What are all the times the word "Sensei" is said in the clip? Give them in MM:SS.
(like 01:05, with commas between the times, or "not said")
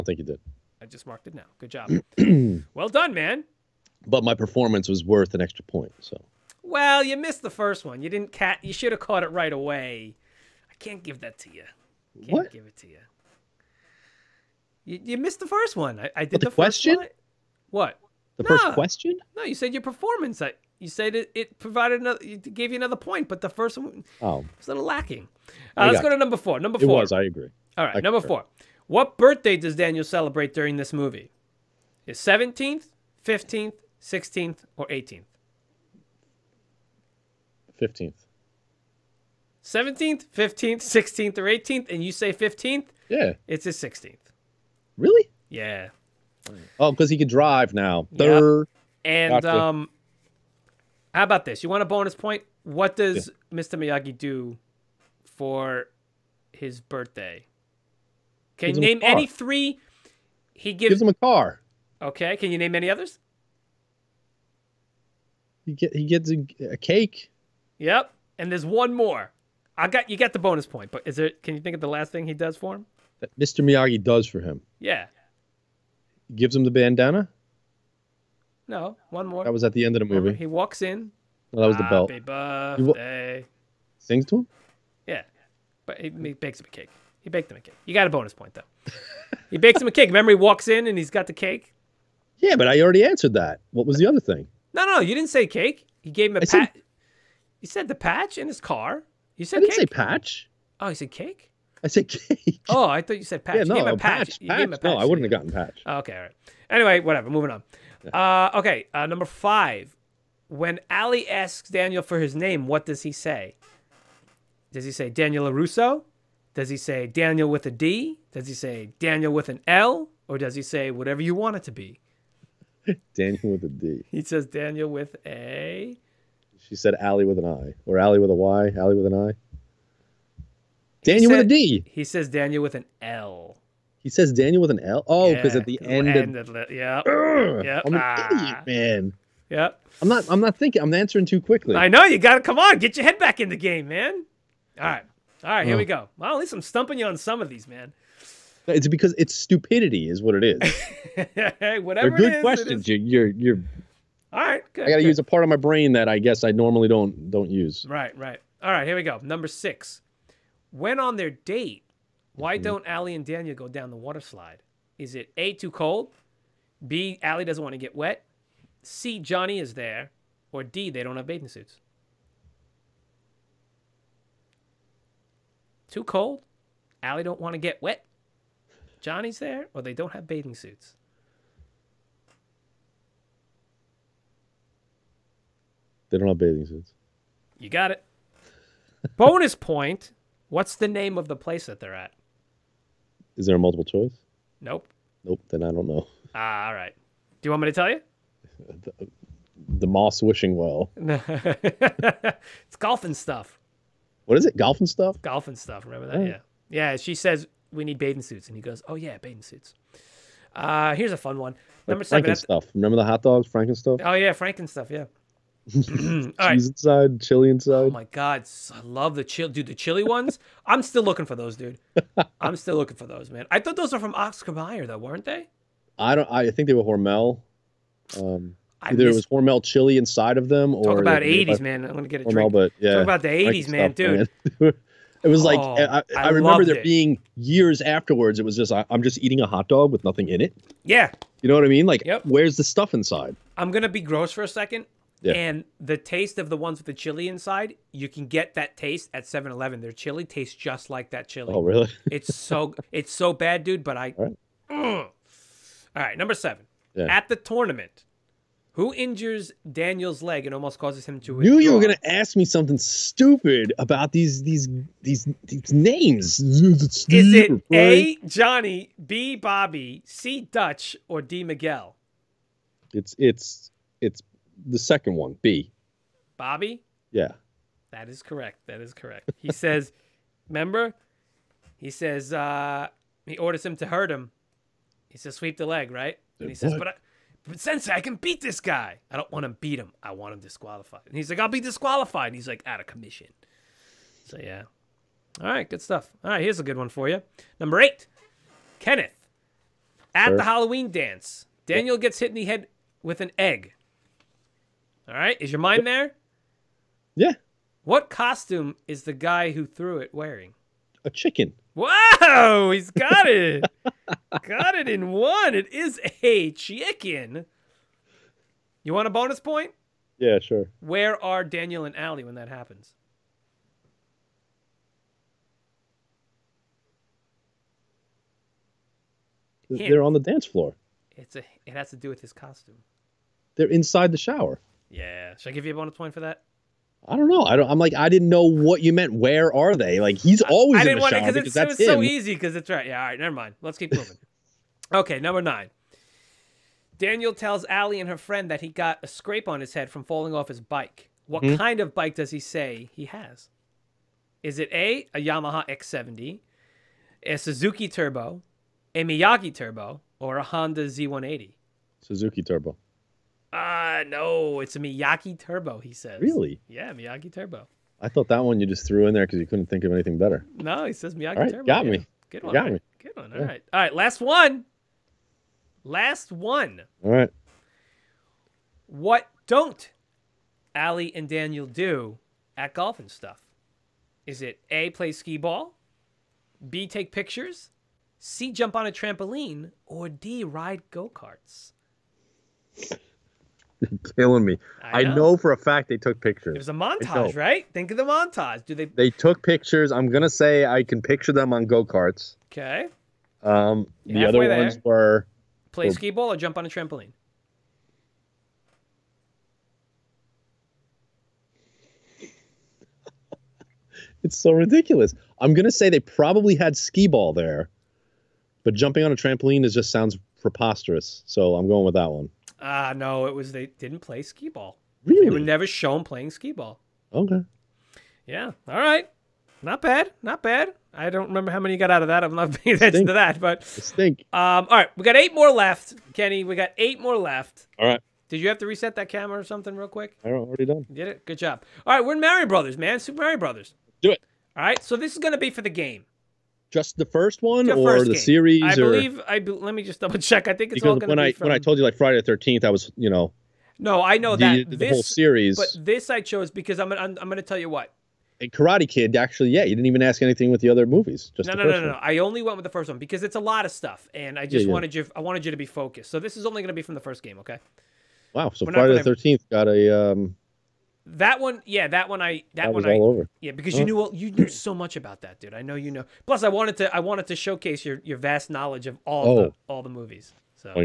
04:47.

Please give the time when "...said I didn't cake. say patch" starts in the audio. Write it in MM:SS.
01:39.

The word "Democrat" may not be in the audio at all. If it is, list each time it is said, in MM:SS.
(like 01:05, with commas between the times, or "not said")
not said.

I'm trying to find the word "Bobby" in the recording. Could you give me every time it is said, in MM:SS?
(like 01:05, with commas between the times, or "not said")
04:29, 04:36.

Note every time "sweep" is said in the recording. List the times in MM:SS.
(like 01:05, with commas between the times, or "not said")
04:45.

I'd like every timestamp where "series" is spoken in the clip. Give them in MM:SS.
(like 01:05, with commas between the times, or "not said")
07:28, 07:35.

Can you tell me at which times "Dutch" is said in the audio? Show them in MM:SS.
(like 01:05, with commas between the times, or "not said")
04:30.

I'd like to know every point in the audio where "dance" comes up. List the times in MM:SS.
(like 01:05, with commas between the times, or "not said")
05:00, 05:30.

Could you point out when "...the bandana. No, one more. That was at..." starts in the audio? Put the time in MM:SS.
01:16.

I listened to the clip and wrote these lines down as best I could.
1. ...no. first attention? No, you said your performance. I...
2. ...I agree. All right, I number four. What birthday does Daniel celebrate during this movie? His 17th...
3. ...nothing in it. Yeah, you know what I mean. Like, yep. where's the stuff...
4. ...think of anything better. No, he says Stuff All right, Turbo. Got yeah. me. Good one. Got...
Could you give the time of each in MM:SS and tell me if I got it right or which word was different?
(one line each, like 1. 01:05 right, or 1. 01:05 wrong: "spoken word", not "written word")
1. 00:18 wrong: "question", not "attention"
2. 00:27 right
3. 04:00 right
4. 06:09 wrong: "Miyaki", not "Stuff".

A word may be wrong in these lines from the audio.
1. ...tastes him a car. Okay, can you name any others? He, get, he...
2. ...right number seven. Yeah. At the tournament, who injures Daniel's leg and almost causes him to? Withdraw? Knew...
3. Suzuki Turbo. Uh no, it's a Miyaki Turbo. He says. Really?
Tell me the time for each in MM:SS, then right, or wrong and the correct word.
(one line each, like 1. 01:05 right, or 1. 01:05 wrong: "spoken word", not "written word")
1. 01:00 wrong: "gives", not "tastes"
2. 04:16 right
3. 06:01 right.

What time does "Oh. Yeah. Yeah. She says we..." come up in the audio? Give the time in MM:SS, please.
03:26.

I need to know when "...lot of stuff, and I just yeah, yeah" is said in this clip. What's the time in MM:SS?
07:43.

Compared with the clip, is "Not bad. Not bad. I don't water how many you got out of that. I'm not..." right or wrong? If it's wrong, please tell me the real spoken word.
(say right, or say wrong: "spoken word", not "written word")
wrong: "remember", not "water".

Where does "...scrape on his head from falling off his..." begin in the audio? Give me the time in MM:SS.
05:49.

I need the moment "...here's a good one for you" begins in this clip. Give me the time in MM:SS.
04:56.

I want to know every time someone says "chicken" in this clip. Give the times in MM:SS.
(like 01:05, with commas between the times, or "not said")
05:11, 05:16.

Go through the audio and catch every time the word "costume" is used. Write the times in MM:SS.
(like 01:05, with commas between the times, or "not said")
05:08, 05:32.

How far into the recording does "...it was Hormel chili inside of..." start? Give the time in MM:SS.
03:49.